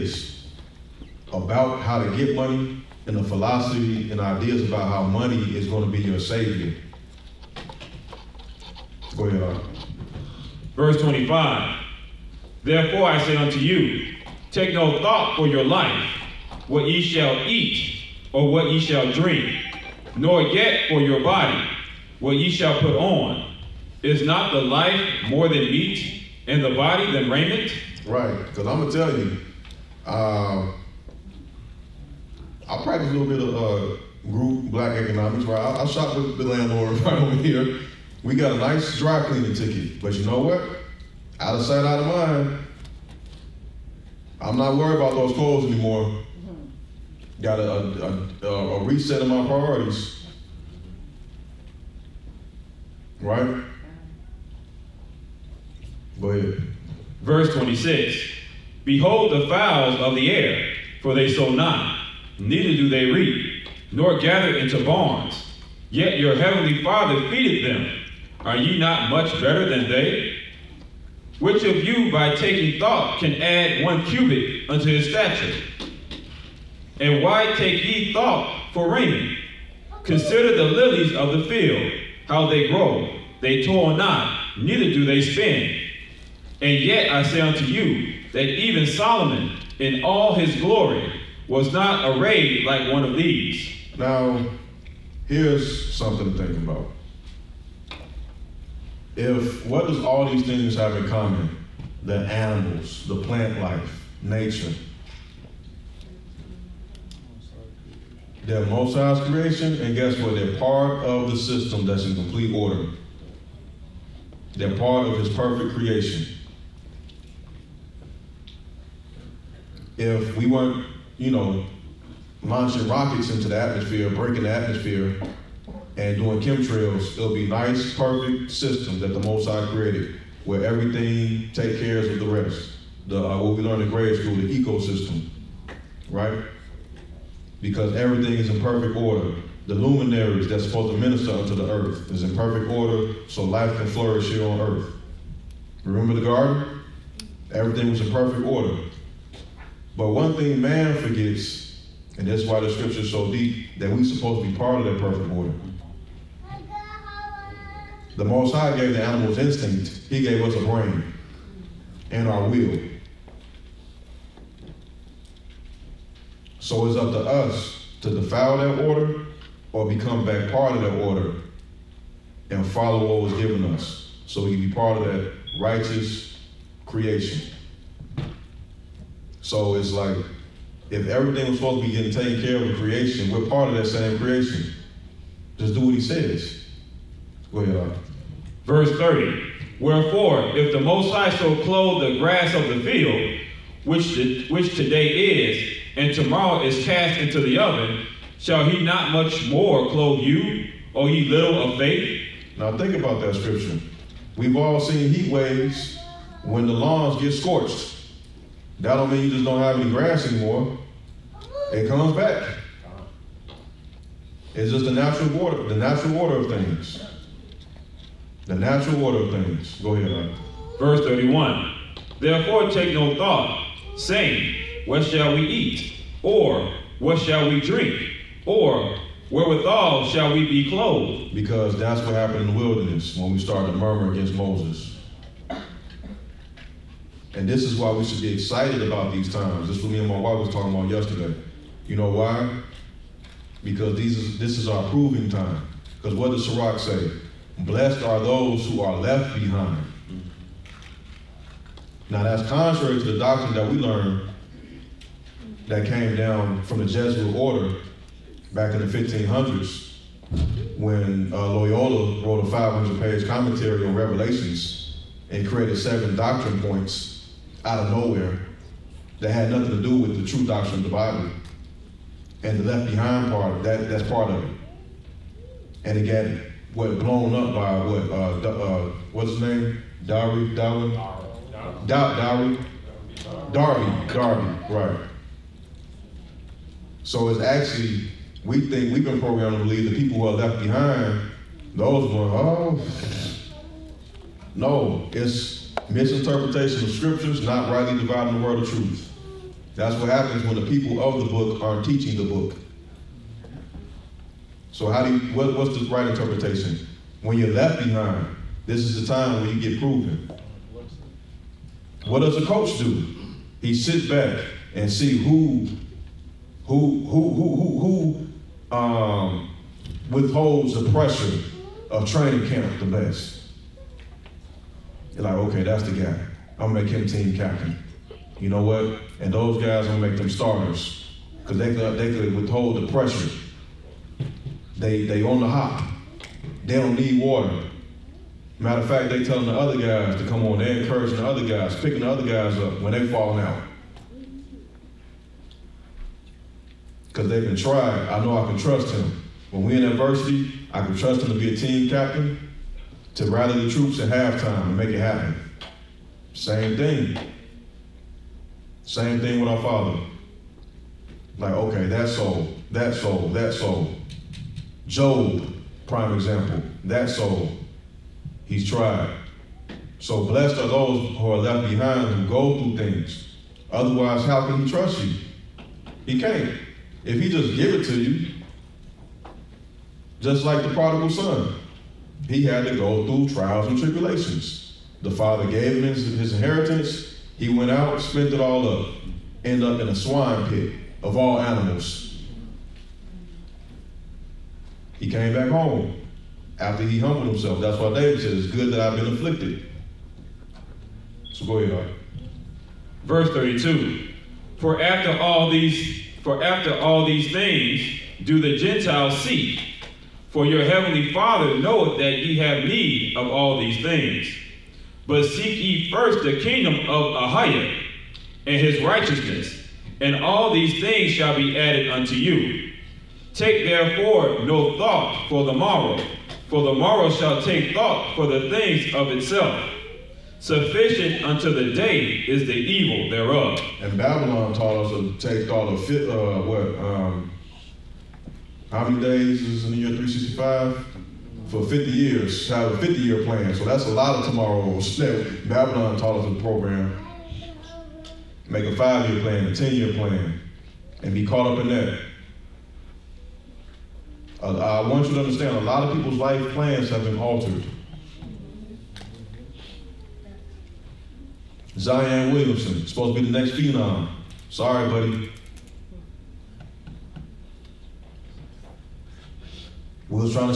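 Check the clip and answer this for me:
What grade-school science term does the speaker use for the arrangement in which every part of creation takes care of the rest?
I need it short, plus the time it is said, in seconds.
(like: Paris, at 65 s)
ecosystem, at 134 s.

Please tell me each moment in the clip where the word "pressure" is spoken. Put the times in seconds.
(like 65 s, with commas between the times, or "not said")
320 s, 332 s.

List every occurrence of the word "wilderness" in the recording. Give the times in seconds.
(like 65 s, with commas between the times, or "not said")
232 s.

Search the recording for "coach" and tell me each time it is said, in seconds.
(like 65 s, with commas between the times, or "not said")
312 s.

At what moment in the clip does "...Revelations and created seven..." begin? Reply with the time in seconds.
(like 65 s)
263 s.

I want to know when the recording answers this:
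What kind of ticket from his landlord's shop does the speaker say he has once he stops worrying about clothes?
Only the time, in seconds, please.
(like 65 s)
38 s.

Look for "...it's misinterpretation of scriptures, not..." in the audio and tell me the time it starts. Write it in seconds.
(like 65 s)
295 s.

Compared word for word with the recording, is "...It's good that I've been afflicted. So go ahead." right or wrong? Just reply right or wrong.
right.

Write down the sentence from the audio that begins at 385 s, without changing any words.
The father gave him his, his inheritance.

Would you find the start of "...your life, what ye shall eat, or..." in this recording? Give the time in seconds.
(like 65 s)
15 s.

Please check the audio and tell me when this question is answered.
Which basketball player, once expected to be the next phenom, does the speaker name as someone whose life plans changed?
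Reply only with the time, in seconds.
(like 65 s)
461 s.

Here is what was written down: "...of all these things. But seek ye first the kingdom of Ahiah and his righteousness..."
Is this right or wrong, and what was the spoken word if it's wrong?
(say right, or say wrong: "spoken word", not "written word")
right.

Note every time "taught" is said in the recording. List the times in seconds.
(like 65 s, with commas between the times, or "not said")
434 s, 445 s.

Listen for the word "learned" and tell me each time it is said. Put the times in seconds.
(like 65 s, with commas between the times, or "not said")
133 s, 253 s.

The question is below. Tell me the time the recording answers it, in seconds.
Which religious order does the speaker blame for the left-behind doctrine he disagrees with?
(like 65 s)
256 s.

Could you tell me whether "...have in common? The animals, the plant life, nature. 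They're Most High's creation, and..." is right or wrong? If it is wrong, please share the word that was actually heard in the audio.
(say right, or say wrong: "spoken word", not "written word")
right.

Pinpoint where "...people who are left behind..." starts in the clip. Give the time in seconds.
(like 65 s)
289 s.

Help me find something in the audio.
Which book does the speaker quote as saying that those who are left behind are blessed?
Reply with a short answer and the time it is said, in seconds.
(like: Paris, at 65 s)
Sirach, at 246 s.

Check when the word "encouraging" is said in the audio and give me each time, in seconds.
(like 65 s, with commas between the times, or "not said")
340 s.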